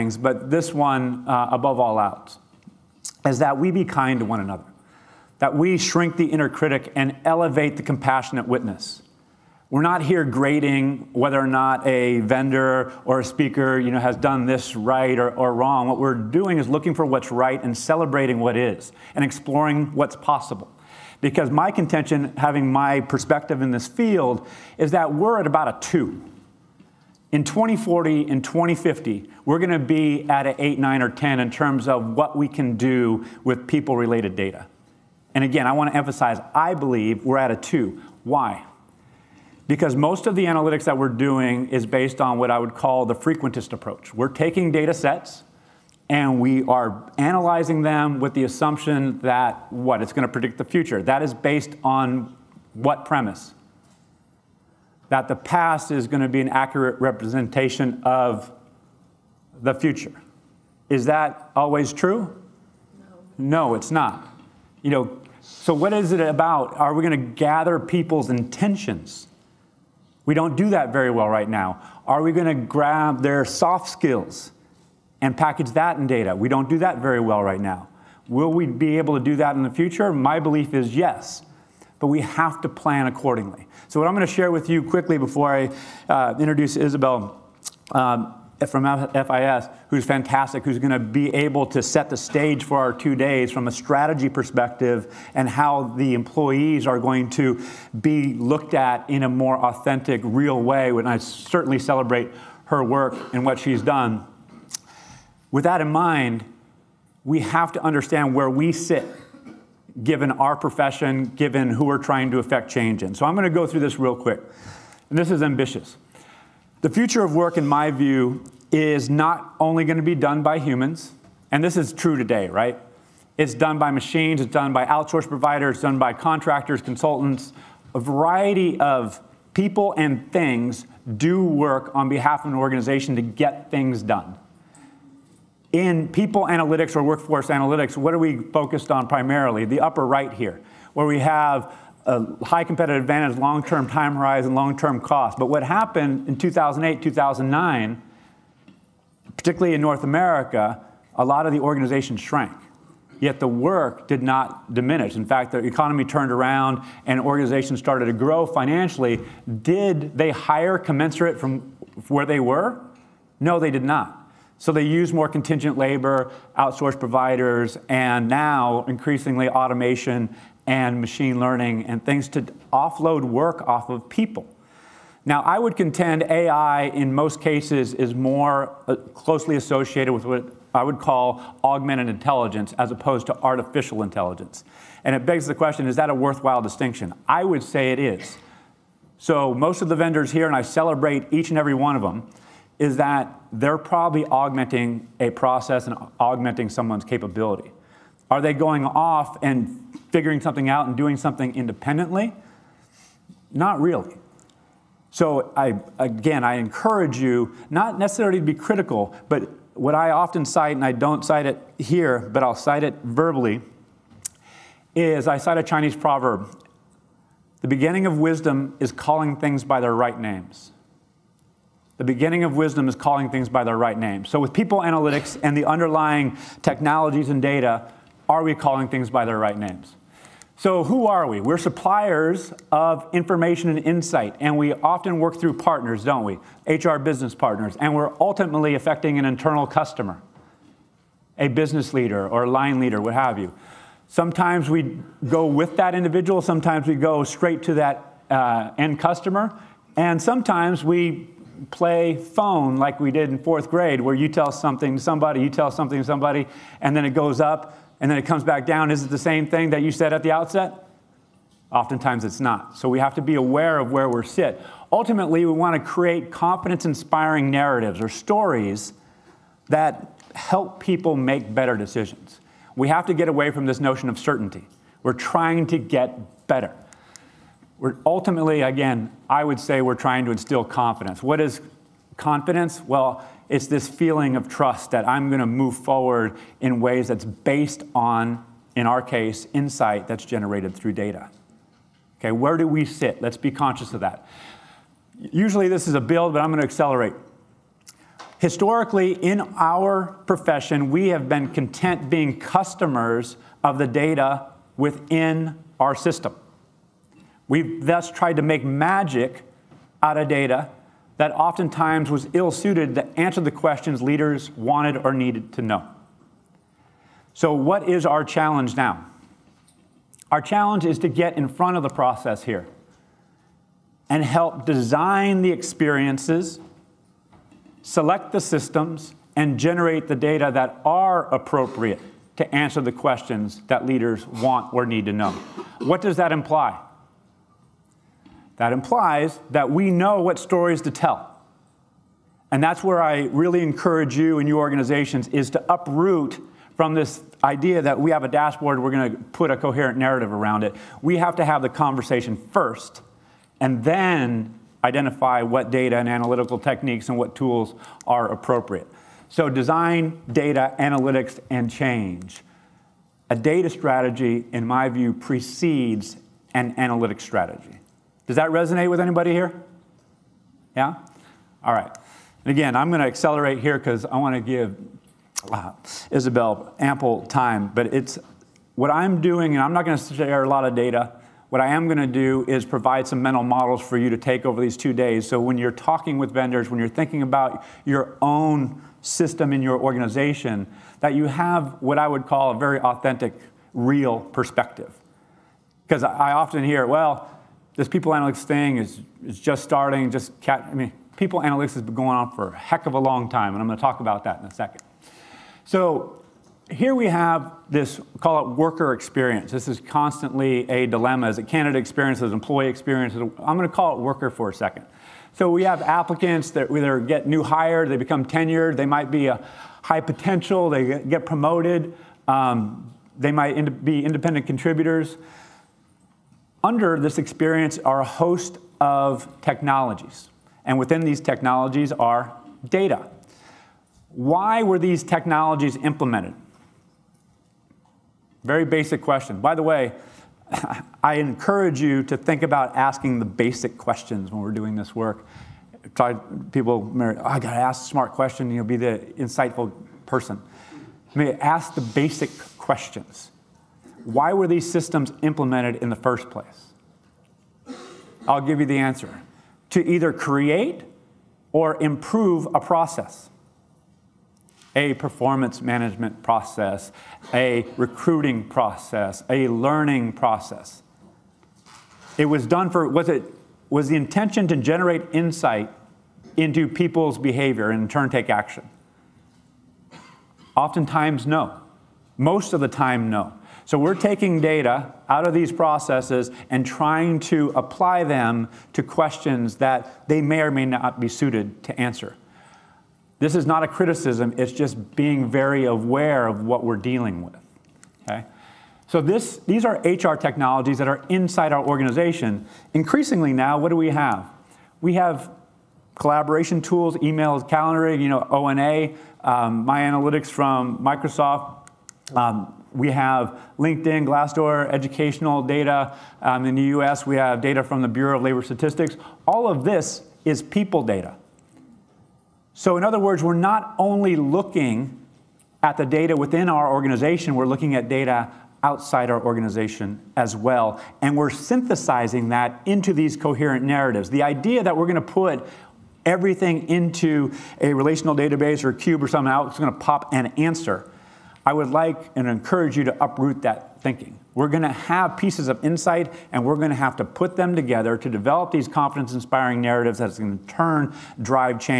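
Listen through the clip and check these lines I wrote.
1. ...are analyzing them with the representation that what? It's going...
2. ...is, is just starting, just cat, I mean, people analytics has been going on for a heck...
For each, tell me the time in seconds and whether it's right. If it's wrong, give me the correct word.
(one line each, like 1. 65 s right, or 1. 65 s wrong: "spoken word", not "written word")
1. 46 s wrong: "assumption", not "representation"
2. 398 s right.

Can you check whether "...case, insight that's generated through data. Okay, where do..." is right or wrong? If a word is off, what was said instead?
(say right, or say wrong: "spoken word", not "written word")
right.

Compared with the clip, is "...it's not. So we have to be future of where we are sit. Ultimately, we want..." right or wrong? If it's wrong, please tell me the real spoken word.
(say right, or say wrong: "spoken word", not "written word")
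wrong: "aware", not "future".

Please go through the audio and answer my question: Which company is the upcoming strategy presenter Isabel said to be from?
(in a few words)
FIS.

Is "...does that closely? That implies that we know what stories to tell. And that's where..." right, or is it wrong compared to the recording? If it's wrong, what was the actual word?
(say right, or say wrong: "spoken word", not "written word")
wrong: "imply", not "closely".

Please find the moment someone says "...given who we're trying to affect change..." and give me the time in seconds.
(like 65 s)
111 s.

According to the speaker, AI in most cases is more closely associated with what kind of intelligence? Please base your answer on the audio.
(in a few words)
augmented intelligence.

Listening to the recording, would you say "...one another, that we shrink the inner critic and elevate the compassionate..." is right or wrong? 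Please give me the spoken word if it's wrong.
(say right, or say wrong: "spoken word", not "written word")
right.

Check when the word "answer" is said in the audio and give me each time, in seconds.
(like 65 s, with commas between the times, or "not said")
313 s, 332 s, 458 s, 491 s, 540 s.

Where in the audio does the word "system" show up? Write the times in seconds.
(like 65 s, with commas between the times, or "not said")
305 s, 328 s, 389 s, 454 s.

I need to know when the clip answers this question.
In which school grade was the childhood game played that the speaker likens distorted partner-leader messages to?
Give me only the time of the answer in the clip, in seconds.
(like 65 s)
253 s.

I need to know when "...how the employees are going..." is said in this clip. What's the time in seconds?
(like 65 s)
95 s.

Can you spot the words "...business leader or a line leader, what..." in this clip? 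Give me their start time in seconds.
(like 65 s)
241 s.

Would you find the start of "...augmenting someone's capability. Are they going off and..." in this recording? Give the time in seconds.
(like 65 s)
196 s.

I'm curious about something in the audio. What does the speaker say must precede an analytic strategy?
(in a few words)
data strategy.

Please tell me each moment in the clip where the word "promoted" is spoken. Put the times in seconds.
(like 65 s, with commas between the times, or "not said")
421 s.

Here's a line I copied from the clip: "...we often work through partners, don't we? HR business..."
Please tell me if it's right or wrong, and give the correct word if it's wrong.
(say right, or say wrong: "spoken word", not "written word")
right.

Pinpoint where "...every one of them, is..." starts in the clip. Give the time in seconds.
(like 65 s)
191 s.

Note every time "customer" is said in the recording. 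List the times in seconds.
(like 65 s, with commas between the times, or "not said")
239 s, 249 s, 302 s.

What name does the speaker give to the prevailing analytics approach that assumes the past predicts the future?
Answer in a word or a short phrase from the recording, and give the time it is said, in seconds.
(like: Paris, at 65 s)
frequentist approach, at 43 s.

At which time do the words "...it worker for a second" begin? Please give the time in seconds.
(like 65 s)
413 s.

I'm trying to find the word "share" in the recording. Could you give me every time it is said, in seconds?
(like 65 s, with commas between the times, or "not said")
84 s, 380 s.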